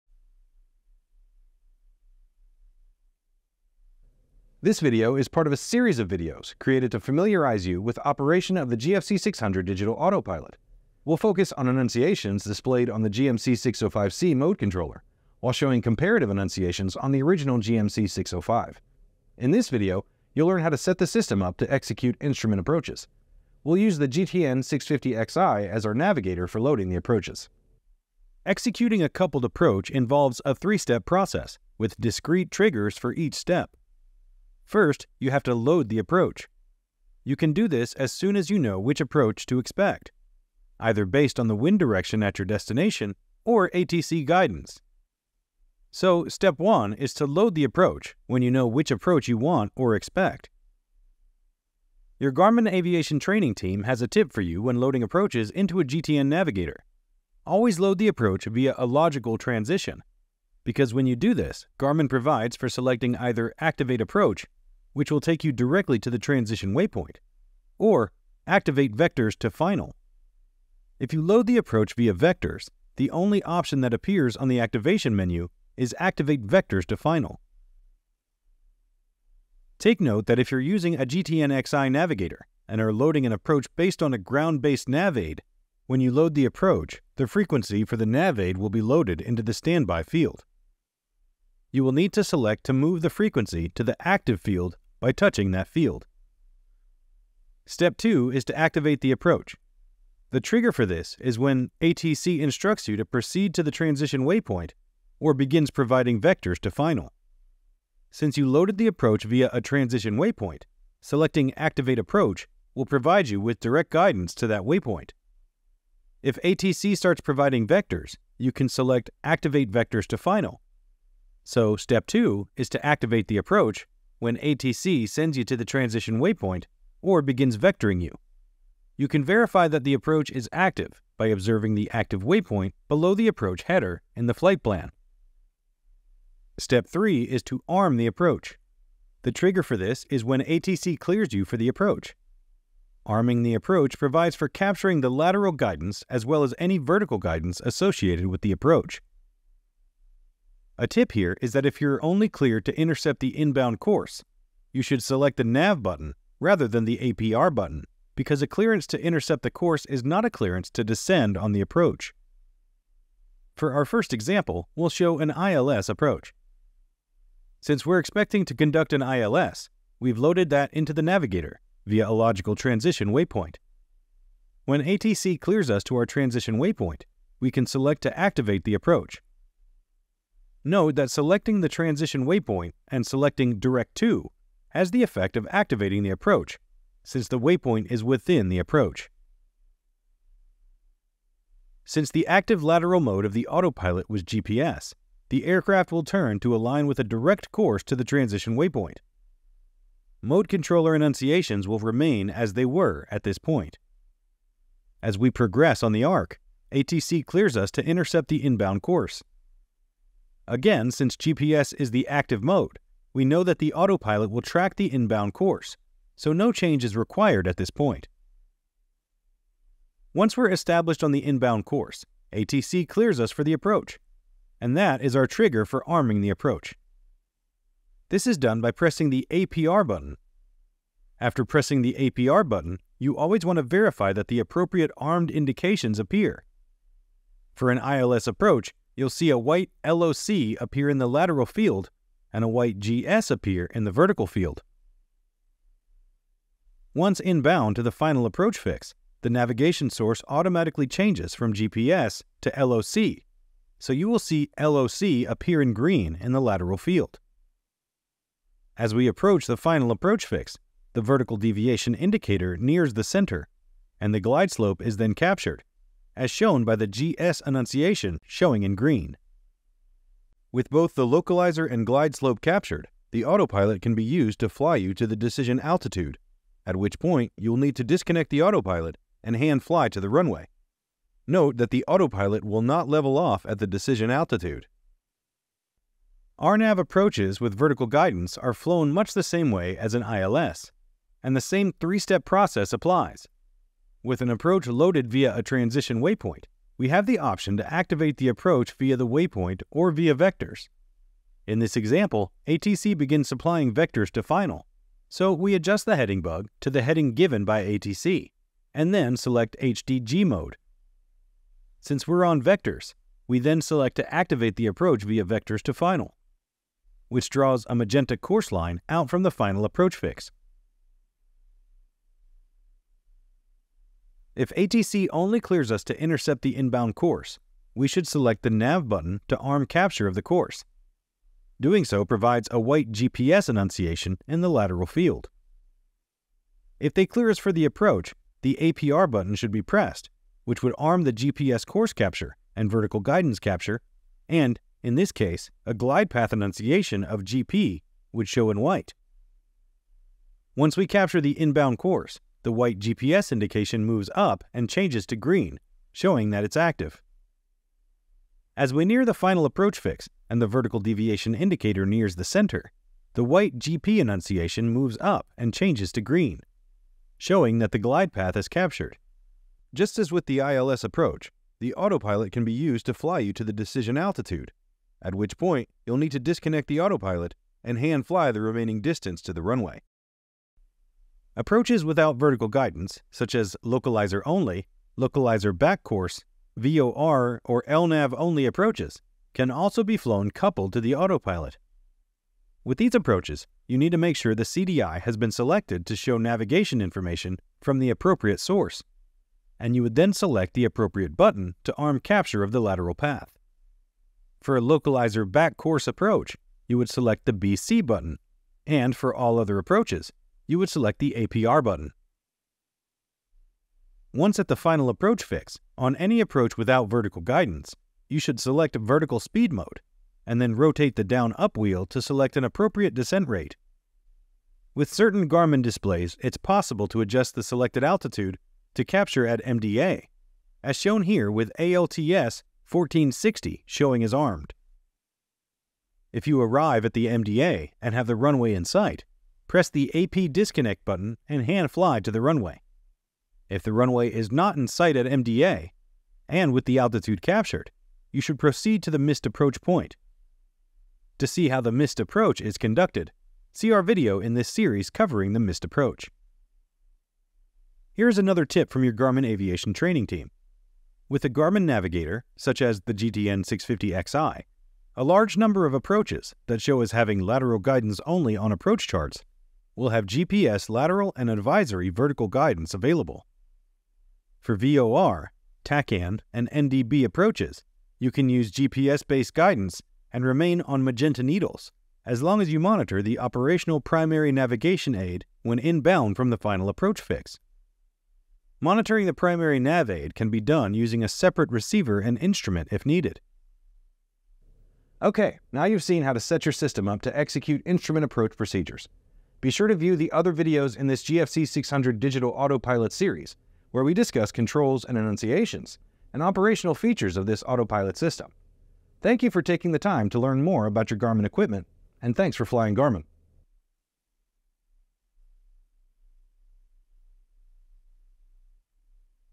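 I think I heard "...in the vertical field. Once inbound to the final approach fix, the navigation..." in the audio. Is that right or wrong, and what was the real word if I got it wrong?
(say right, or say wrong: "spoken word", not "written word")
right.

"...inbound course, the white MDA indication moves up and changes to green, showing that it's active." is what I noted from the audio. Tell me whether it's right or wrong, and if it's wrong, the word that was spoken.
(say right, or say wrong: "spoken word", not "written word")
wrong: "GPS", not "MDA".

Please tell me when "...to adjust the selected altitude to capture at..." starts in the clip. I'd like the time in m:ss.
7:06.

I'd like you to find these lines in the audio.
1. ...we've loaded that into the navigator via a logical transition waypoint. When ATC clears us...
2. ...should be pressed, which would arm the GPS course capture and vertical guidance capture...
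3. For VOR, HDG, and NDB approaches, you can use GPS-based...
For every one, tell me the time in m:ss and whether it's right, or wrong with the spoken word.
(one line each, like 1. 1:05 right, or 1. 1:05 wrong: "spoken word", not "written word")
1. 2:49 right
2. 5:39 right
3. 7:54 wrong: "TACAN", not "HDG".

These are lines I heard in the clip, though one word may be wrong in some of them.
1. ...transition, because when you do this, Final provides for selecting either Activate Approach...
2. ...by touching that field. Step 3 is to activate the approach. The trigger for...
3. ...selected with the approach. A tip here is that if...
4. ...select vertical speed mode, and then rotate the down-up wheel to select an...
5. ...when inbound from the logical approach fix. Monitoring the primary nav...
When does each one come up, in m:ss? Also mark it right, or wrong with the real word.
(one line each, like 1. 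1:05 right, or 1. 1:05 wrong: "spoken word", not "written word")
1. 0:59 wrong: "Garmin", not "Final"
2. 1:35 wrong: "2", not "3"
3. 2:27 wrong: "associated", not "selected"
4. 6:58 right
5. 8:05 wrong: "final", not "logical".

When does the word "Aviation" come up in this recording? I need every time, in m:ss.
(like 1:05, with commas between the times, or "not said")
0:52, 7:39.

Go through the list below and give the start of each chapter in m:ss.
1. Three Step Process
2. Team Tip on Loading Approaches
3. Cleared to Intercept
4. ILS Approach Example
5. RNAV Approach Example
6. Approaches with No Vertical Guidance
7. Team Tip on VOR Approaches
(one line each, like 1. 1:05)
1. 0:28
2. 0:51
3. 2:30
4. 2:43
5. 4:43
6. 6:16
7. 7:34.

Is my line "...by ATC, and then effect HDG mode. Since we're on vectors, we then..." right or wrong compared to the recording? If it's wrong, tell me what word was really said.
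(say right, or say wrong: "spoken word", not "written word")
wrong: "select", not "effect".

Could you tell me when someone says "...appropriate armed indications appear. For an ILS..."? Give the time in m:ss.
3:54.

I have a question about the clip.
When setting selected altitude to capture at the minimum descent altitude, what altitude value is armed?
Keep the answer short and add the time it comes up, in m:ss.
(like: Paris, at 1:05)
1460, at 7:12.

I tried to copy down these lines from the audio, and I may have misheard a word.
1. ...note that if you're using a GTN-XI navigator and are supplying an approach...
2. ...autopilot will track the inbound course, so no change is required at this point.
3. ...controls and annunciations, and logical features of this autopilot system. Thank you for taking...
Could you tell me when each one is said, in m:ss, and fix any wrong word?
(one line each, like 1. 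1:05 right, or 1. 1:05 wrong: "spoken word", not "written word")
1. 1:20 wrong: "loading", not "supplying"
2. 3:33 right
3. 8:24 wrong: "operational", not "logical".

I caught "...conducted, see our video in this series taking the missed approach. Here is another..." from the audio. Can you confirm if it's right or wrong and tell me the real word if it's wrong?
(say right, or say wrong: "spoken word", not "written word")
wrong: "covering", not "taking".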